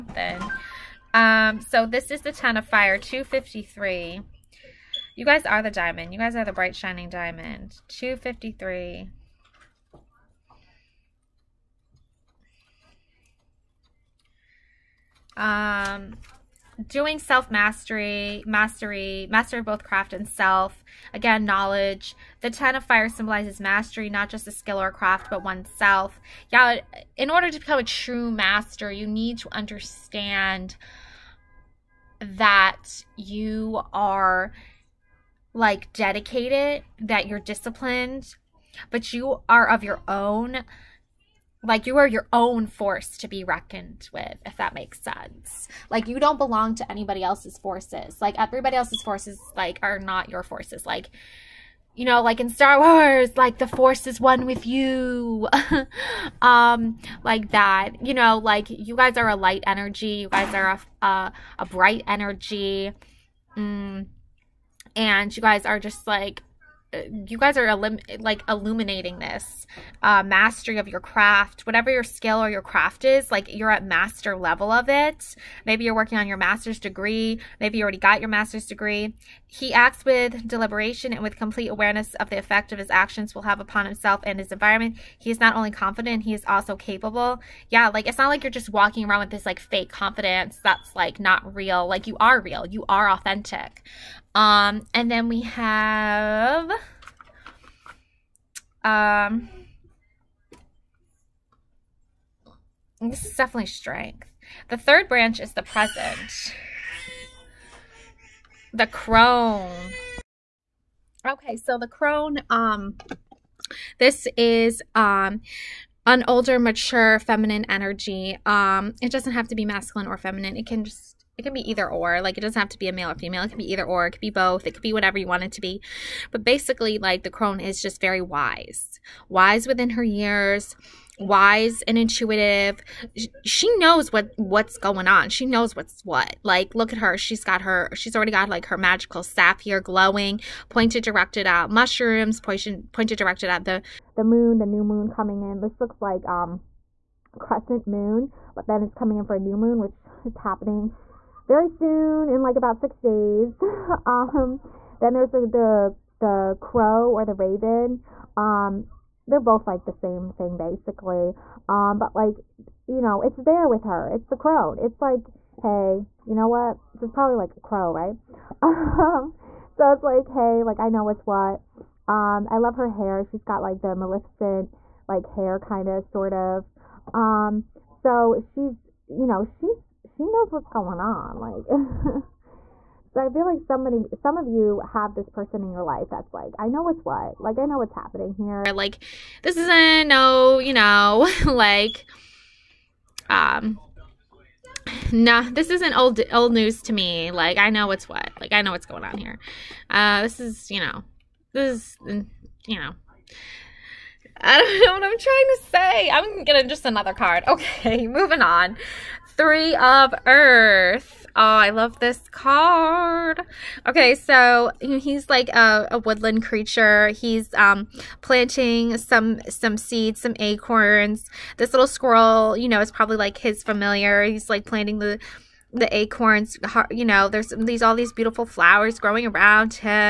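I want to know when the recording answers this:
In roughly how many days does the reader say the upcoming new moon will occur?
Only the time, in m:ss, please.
2:32.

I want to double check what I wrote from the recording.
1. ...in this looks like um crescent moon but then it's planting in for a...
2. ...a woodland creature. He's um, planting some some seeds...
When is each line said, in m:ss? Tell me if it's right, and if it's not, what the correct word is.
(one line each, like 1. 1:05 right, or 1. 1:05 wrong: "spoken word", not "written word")
1. 2:25 wrong: "coming", not "planting"
2. 3:35 right.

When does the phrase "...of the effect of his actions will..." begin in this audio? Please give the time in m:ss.
1:22.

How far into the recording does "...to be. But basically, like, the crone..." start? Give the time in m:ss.
2:05.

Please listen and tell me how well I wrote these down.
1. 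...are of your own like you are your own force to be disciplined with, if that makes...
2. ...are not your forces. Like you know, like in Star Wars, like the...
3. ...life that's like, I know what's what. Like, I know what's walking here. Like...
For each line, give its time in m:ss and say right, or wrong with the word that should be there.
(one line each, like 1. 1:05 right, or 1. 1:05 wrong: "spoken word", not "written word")
1. 0:39 wrong: "reckoned", not "disciplined"
2. 0:49 right
3. 3:05 wrong: "happening", not "walking".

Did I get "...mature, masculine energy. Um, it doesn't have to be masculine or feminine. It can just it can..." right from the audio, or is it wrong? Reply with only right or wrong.
wrong.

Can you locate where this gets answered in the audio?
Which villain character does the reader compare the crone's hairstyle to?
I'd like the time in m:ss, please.
2:53.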